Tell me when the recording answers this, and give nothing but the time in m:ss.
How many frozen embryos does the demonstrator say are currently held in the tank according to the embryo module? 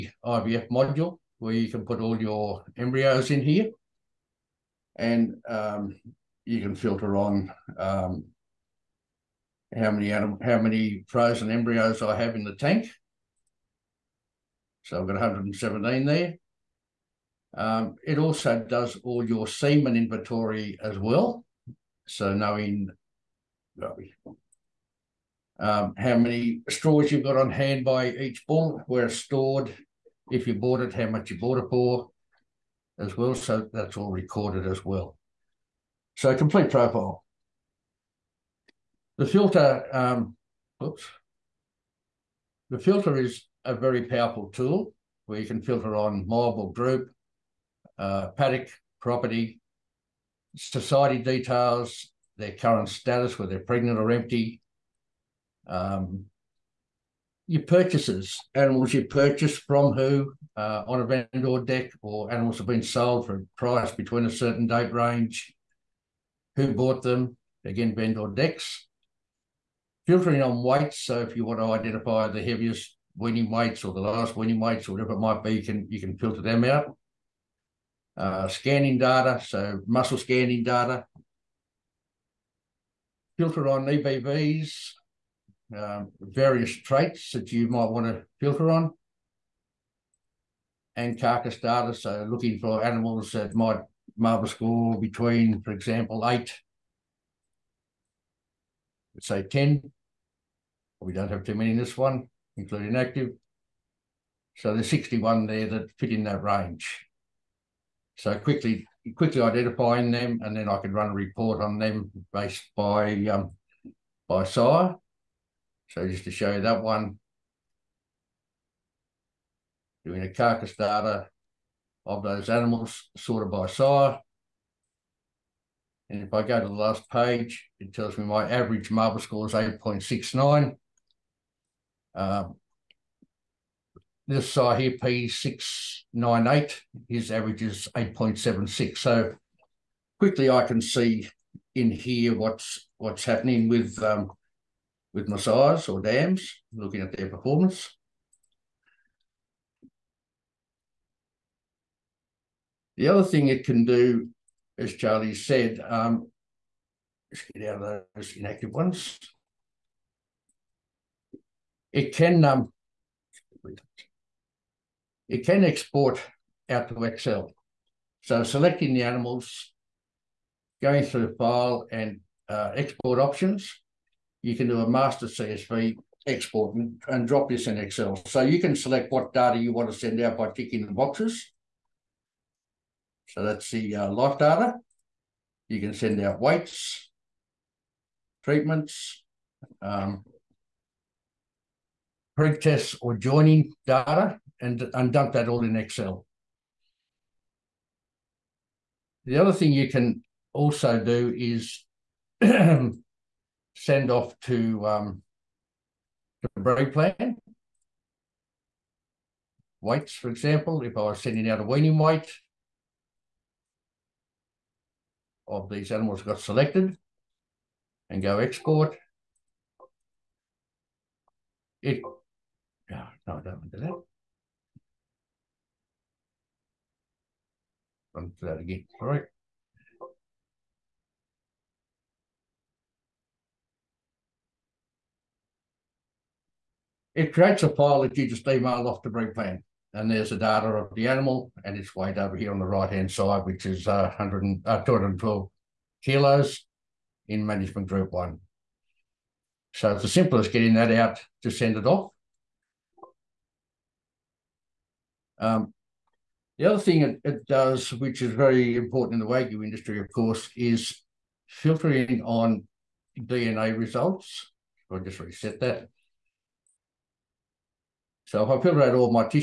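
0:15.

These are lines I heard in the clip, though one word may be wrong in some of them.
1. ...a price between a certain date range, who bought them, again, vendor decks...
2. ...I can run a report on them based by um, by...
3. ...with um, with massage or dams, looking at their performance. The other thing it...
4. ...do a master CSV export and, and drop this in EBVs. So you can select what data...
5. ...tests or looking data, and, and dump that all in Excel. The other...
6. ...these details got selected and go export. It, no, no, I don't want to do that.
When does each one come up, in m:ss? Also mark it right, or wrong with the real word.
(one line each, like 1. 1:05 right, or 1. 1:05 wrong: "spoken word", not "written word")
1. 1:03 right
2. 1:50 right
3. 2:23 right
4. 2:54 wrong: "Excel", not "EBVs"
5. 3:12 wrong: "joining", not "looking"
6. 3:35 wrong: "animals", not "details".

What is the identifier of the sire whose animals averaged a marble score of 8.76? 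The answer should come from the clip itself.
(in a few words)
P698.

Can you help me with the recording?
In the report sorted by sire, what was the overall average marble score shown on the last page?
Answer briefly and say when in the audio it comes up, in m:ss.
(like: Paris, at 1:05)
8.69, at 2:09.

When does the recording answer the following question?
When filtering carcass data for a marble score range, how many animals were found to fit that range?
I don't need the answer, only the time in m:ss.
1:44.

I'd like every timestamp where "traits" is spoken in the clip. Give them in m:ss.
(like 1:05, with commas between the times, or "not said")
1:26.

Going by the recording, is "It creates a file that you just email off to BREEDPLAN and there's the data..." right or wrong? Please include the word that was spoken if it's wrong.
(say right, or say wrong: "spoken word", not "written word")
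right.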